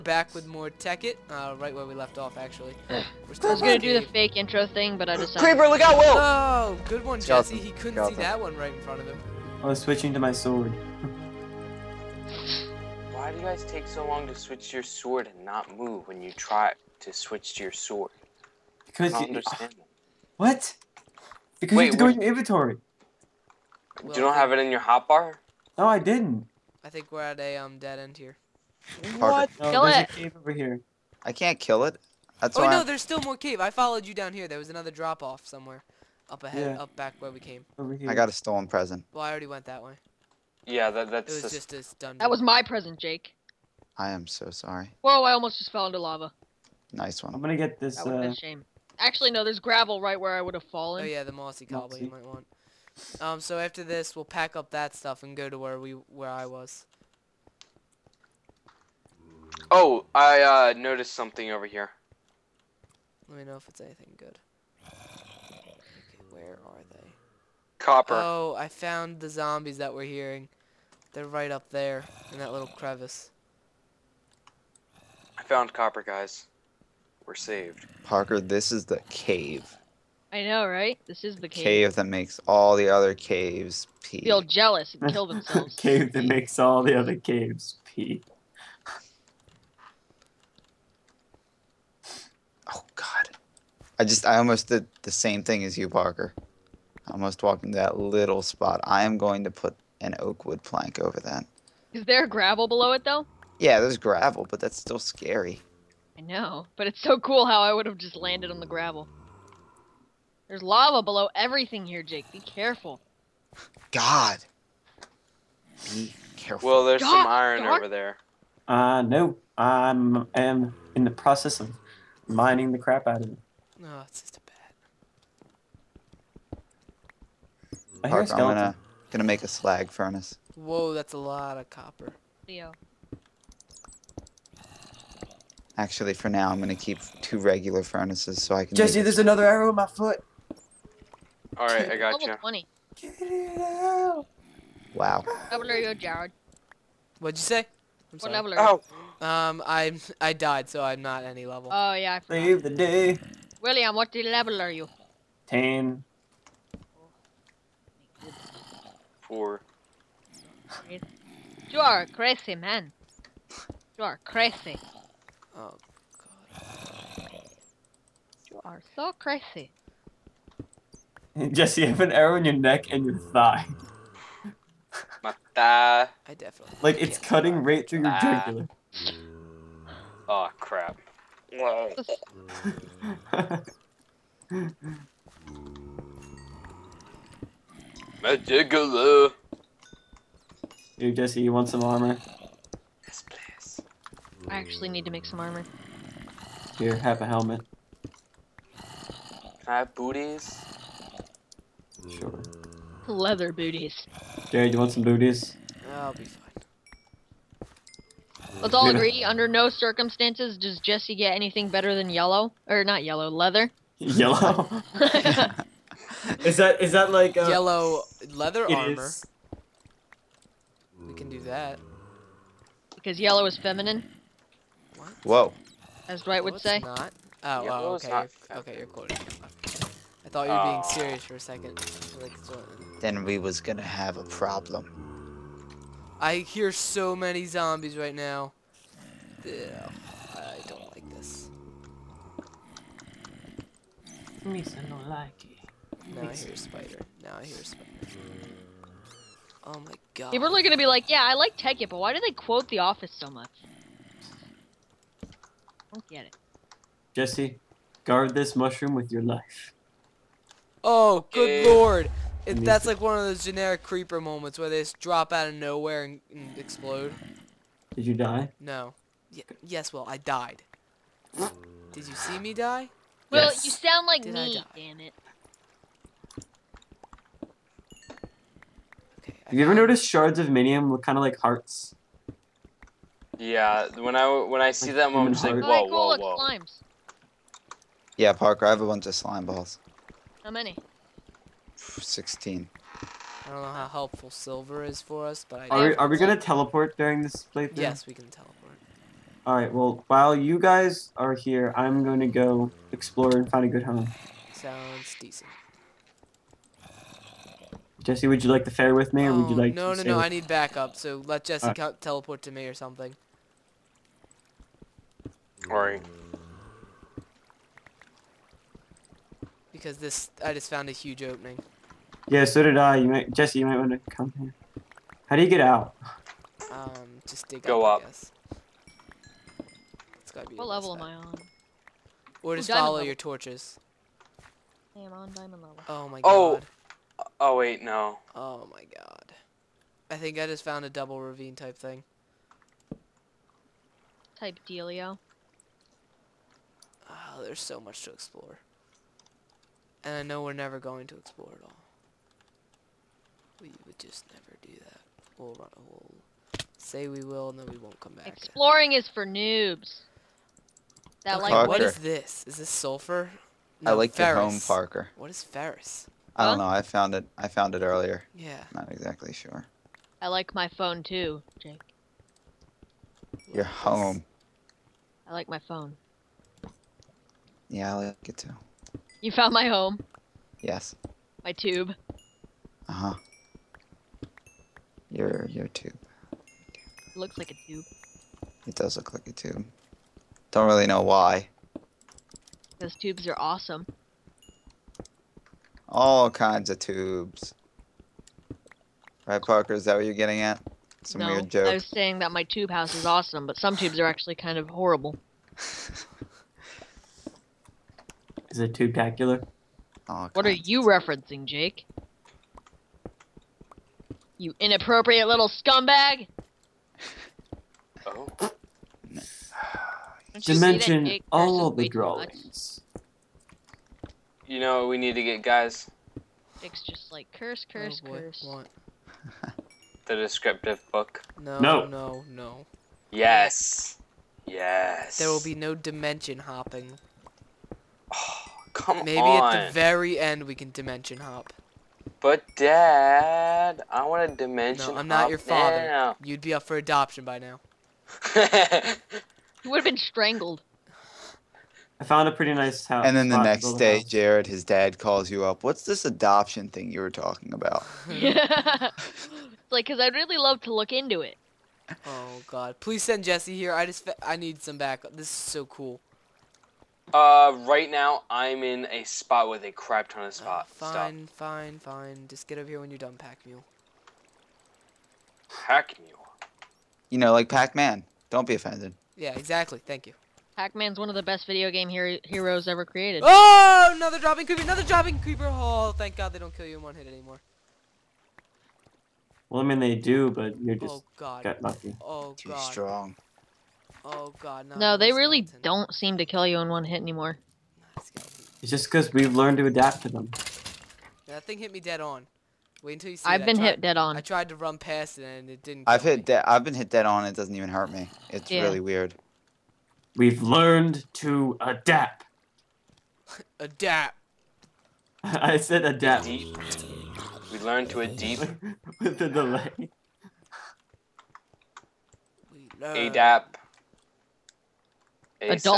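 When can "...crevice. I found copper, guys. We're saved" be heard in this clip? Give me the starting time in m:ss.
1:12.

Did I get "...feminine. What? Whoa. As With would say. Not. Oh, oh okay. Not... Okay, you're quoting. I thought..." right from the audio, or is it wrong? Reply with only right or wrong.
wrong.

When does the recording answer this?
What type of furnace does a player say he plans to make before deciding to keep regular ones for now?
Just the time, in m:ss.
2:09.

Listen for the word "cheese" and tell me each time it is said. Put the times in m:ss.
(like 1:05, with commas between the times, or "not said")
not said.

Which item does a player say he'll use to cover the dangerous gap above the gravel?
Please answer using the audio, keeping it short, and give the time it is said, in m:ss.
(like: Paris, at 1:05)
Oak wood plank, at 1:40.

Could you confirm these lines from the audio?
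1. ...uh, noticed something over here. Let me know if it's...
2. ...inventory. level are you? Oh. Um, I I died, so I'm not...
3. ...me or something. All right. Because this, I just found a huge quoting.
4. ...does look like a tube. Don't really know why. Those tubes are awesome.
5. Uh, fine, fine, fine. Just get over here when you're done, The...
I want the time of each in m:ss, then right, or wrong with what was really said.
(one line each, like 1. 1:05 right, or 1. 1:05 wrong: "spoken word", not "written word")
1. 1:00 right
2. 2:28 wrong: "sorry", not "inventory"
3. 5:12 wrong: "opening", not "quoting"
4. 6:28 right
5. 7:50 wrong: "Pack", not "The".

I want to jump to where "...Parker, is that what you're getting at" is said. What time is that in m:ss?
6:39.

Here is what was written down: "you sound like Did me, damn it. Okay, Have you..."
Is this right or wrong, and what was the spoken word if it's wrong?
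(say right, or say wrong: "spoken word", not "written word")
right.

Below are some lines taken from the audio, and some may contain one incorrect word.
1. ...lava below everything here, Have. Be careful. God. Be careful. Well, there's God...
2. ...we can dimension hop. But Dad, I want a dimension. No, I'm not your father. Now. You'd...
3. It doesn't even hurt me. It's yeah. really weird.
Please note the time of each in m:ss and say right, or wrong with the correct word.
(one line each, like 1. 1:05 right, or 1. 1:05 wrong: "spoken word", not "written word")
1. 1:50 wrong: "Jake", not "Have"
2. 7:20 right
3. 8:27 right.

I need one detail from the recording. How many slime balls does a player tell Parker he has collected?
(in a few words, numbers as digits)
16.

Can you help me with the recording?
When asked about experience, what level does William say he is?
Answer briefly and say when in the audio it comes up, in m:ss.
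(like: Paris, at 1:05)
10, at 2:35.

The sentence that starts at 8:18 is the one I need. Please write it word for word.
It's just because we've learned to adapt to them.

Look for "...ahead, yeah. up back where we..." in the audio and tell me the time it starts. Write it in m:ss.
0:36.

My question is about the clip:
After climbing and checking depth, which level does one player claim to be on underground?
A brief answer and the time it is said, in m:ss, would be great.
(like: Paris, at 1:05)
Diamond level, at 5:35.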